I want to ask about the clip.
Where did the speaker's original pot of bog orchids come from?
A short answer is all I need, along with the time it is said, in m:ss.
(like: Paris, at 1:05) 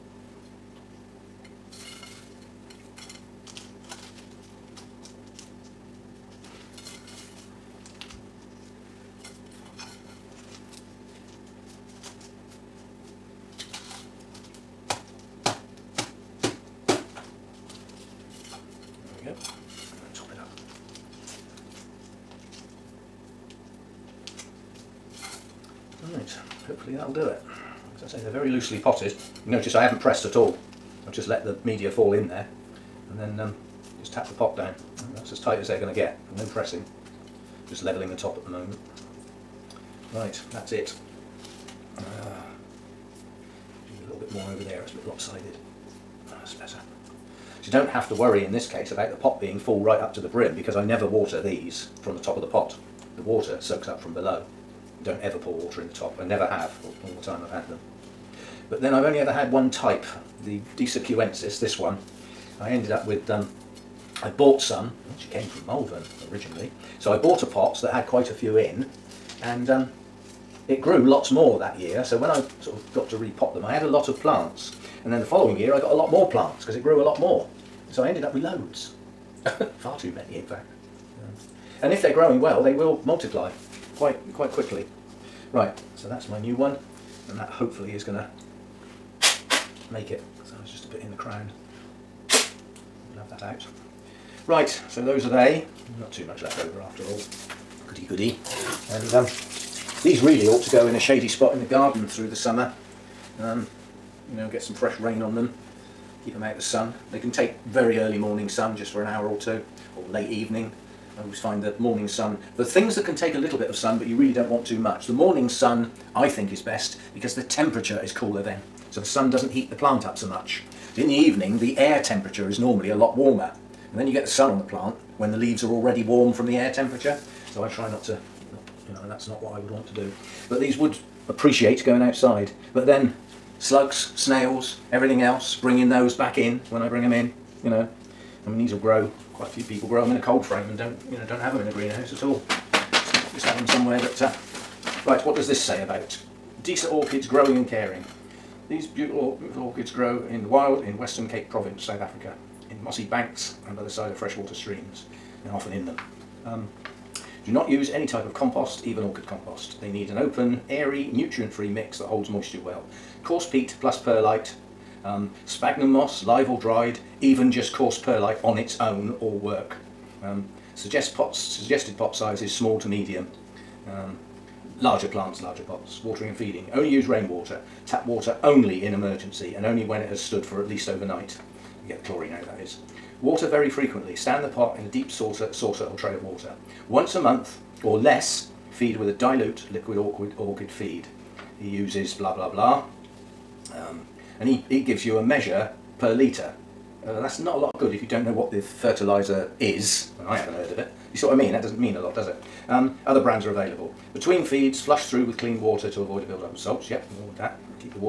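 Malvern, at 1:05.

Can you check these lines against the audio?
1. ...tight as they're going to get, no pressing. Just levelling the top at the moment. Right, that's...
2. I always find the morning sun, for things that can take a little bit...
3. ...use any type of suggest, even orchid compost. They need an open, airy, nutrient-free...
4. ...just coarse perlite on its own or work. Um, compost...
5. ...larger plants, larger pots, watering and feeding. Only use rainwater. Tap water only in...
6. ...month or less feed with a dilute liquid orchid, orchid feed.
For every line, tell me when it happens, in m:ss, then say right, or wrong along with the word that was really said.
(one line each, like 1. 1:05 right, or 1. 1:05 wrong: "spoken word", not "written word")
1. 0:35 right
2. 1:51 right
3. 2:37 wrong: "compost", not "suggest"
4. 2:47 wrong: "suggest", not "compost"
5. 2:54 right
6. 3:07 right.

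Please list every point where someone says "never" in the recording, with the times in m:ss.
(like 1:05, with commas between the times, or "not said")
0:50, 0:56.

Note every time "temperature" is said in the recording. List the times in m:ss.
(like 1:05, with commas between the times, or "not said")
1:57, 2:02, 2:06.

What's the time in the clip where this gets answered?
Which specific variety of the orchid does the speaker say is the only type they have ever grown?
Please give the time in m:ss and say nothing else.
1:00.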